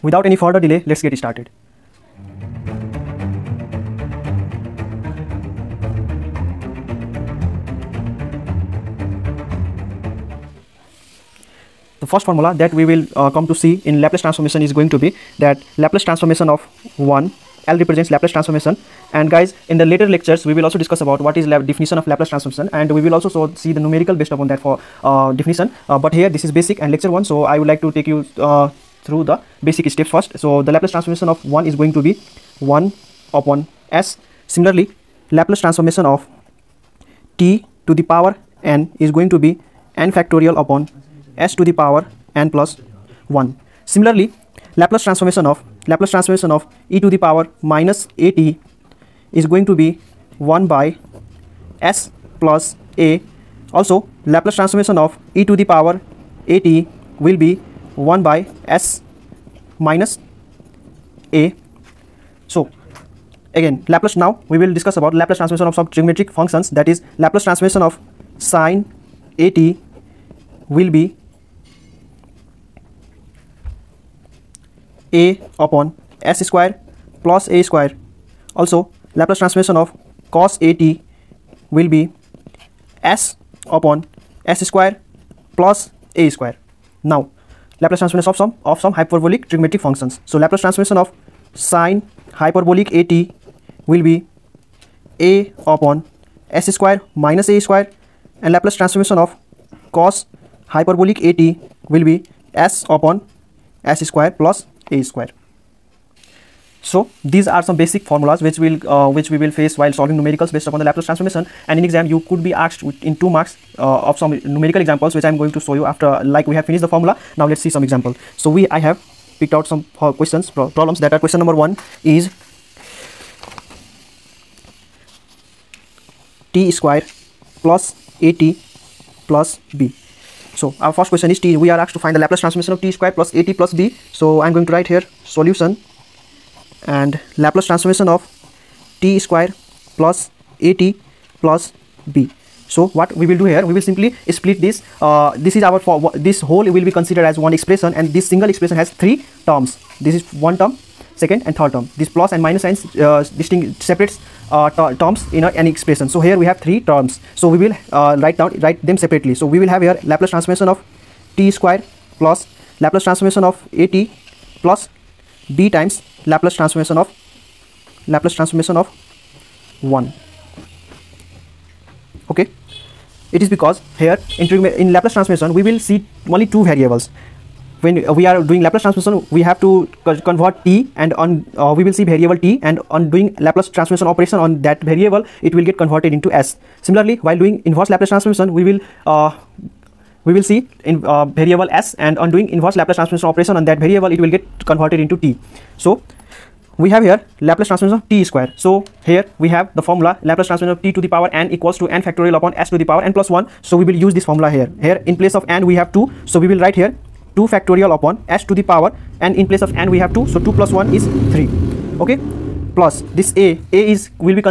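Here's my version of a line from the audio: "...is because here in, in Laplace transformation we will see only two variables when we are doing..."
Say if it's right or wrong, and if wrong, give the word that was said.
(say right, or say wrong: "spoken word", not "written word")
right.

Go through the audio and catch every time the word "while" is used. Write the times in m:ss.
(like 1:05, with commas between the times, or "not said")
1:49, 3:07.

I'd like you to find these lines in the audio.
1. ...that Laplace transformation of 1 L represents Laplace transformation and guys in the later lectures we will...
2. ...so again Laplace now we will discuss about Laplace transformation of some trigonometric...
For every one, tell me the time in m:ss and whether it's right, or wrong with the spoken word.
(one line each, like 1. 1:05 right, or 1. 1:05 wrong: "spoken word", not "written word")
1. 0:15 right
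2. 1:02 right.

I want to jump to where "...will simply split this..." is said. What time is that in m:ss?
2:23.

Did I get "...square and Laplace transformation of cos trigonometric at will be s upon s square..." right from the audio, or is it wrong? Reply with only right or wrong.
wrong.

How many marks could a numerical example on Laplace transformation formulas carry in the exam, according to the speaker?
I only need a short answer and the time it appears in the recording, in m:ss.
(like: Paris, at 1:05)
2 marks, at 1:53.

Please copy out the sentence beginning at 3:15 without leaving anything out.
So we have here Laplace transformation of t square.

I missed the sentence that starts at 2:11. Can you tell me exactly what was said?
We are asked to find the Laplace transformation of t square plus at plus b.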